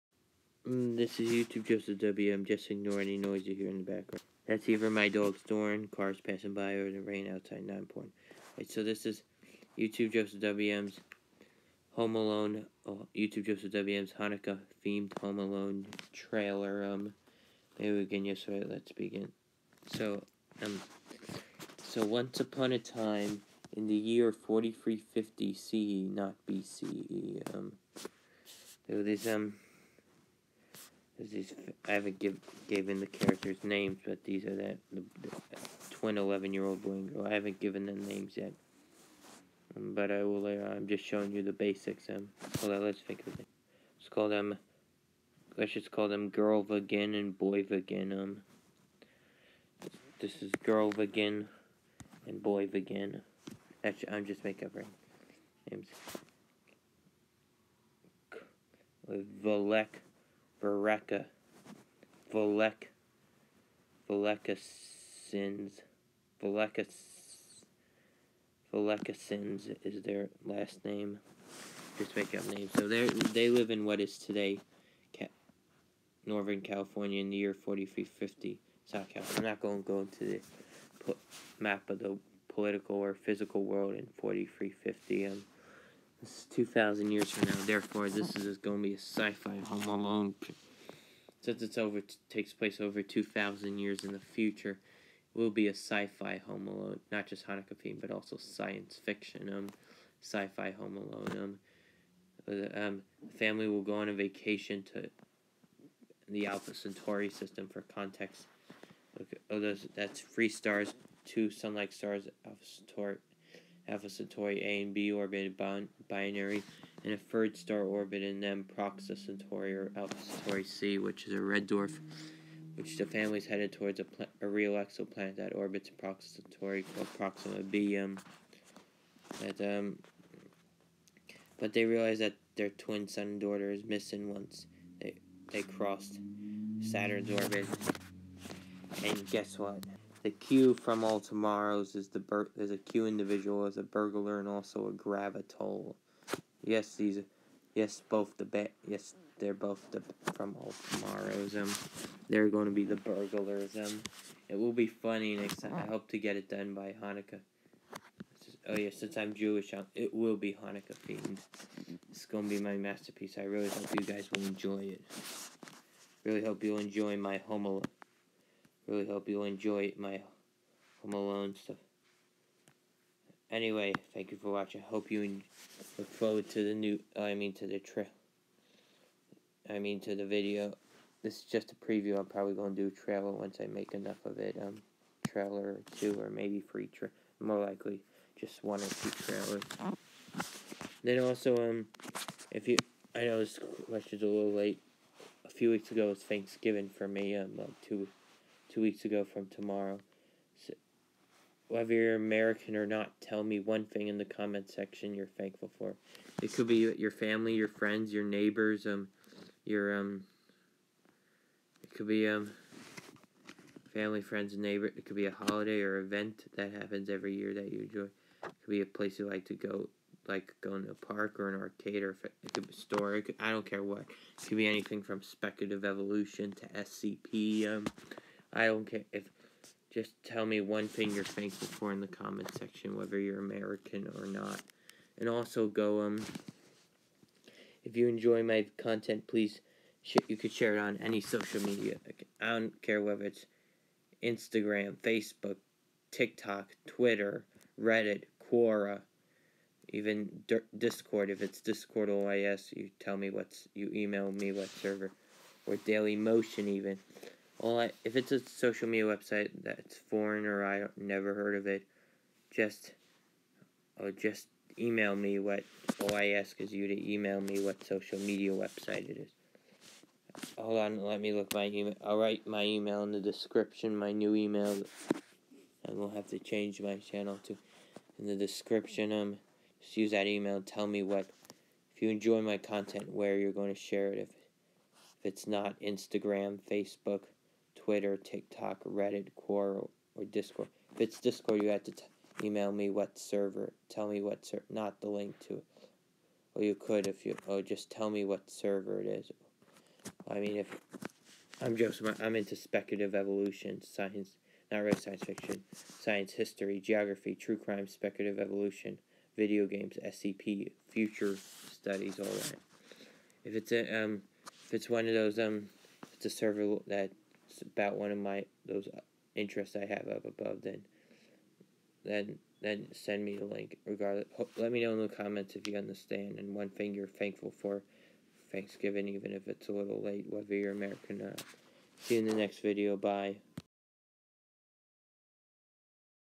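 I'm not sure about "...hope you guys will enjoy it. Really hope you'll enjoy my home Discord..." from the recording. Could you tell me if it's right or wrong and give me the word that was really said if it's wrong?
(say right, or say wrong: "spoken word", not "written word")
wrong: "Really", not "Discord".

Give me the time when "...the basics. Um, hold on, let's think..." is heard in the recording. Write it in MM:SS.
00:41.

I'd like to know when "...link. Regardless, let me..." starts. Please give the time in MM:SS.
05:23.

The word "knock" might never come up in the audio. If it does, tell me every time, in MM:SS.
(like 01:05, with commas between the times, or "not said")
not said.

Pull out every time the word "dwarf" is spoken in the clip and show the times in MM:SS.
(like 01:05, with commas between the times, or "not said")
02:01.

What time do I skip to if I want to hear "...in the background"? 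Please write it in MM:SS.
00:03.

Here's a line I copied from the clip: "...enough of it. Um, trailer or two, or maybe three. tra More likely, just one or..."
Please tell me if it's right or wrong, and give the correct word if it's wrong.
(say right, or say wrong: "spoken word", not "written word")
right.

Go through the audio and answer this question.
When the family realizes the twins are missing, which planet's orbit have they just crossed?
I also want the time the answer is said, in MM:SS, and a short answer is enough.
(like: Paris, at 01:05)
Saturn, at 02:16.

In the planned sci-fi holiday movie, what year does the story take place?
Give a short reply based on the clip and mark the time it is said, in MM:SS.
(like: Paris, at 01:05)
4350 CE, at 00:23.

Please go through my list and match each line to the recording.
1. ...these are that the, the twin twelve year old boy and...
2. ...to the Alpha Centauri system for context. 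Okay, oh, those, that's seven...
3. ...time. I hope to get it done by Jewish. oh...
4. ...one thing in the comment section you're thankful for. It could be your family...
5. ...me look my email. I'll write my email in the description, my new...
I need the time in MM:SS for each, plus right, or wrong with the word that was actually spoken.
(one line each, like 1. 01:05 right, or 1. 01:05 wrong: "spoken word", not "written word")
1. 00:34 wrong: "eleven", not "twelve"
2. 01:44 wrong: "three", not "seven"
3. 02:35 wrong: "Hanukkah", not "Jewish"
4. 03:23 right
5. 04:31 right.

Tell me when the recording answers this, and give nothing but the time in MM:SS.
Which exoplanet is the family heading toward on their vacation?
02:07.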